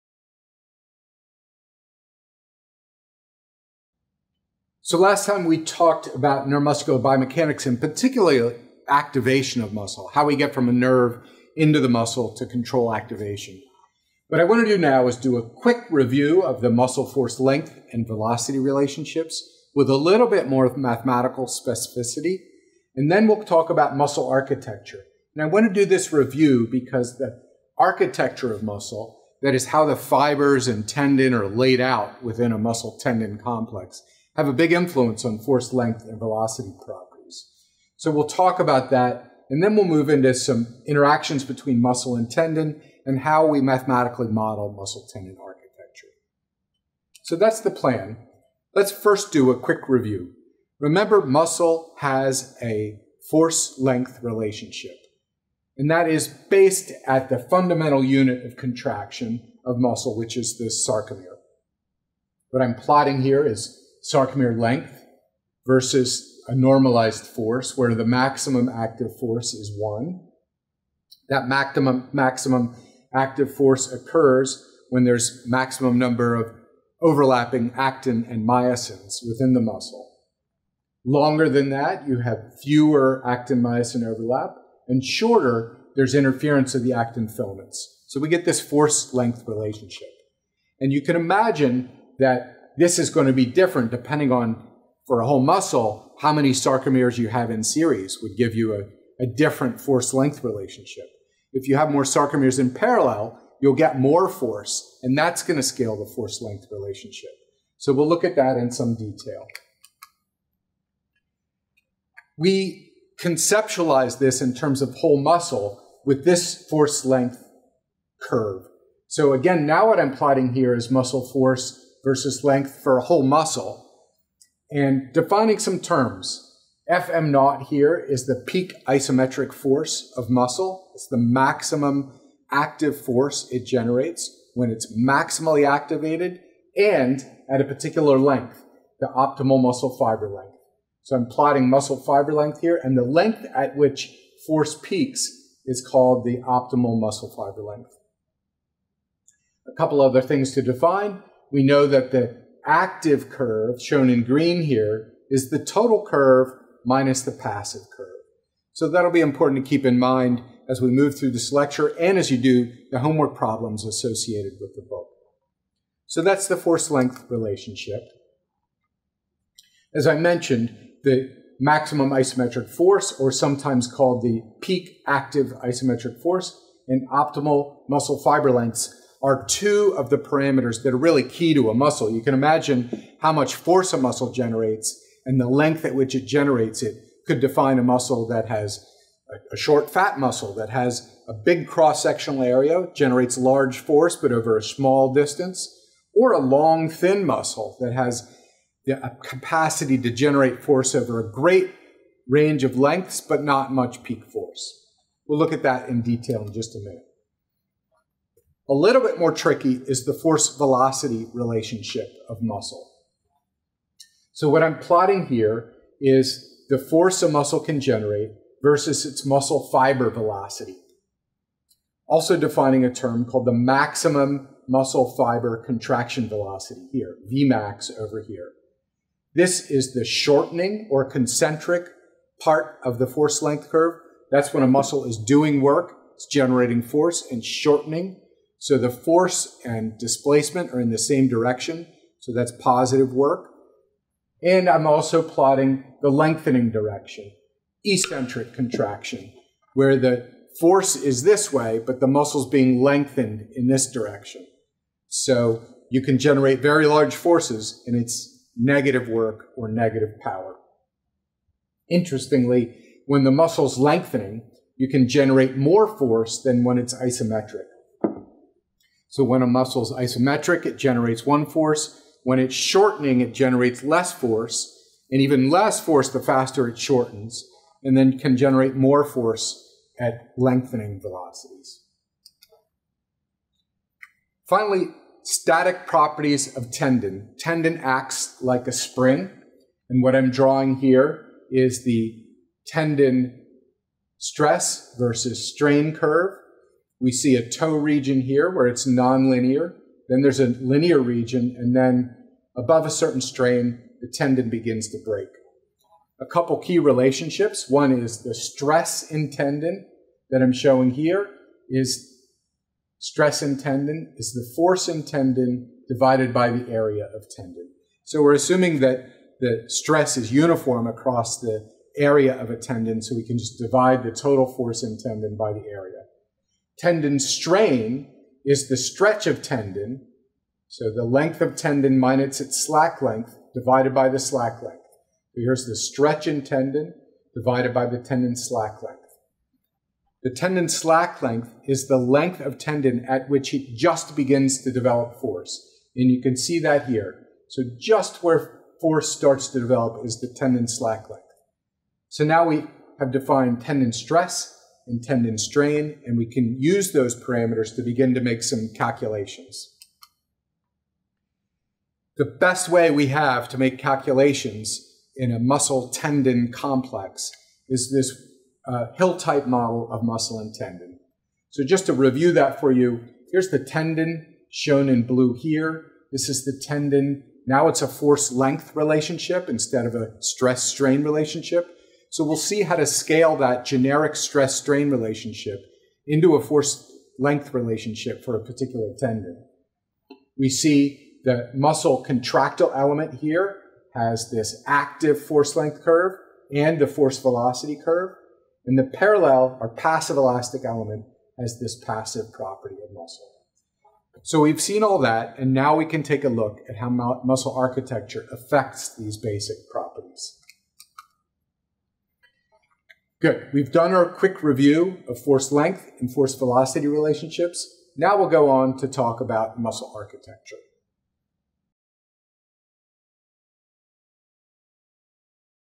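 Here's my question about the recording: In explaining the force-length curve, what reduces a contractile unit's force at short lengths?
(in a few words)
interference of the actin filaments.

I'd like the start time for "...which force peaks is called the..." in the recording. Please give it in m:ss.
2:23.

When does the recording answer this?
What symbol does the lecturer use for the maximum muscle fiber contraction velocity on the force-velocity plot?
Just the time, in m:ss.
3:47.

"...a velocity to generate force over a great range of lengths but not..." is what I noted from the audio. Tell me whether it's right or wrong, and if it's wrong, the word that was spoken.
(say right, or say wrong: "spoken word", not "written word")
wrong: "capacity", not "velocity".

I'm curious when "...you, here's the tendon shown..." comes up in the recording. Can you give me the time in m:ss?
6:12.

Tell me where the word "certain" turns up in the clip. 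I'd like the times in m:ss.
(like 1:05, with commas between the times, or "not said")
5:02.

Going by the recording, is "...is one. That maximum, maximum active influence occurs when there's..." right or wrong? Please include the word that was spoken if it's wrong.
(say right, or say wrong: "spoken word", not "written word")
wrong: "force", not "influence".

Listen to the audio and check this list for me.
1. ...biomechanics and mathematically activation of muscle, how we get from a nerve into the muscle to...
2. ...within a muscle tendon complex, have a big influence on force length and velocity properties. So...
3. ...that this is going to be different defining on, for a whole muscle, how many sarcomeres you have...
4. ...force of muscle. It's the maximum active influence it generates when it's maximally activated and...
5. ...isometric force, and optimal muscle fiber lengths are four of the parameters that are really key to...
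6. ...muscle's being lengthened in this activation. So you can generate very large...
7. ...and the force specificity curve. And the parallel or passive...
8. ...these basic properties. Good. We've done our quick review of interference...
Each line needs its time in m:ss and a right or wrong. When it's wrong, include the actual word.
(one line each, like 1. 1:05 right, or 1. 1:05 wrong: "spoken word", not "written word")
1. 0:07 wrong: "particularly", not "mathematically"
2. 0:32 right
3. 1:32 wrong: "depending", not "defining"
4. 2:09 wrong: "force", not "influence"
5. 2:55 wrong: "two", not "four"
6. 4:12 wrong: "direction", not "activation"
7. 6:36 wrong: "velocity", not "specificity"
8. 6:48 wrong: "force", not "interference".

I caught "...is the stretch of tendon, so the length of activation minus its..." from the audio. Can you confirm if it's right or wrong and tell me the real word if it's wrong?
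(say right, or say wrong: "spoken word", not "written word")
wrong: "tendon", not "activation".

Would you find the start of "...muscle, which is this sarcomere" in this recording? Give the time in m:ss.
0:59.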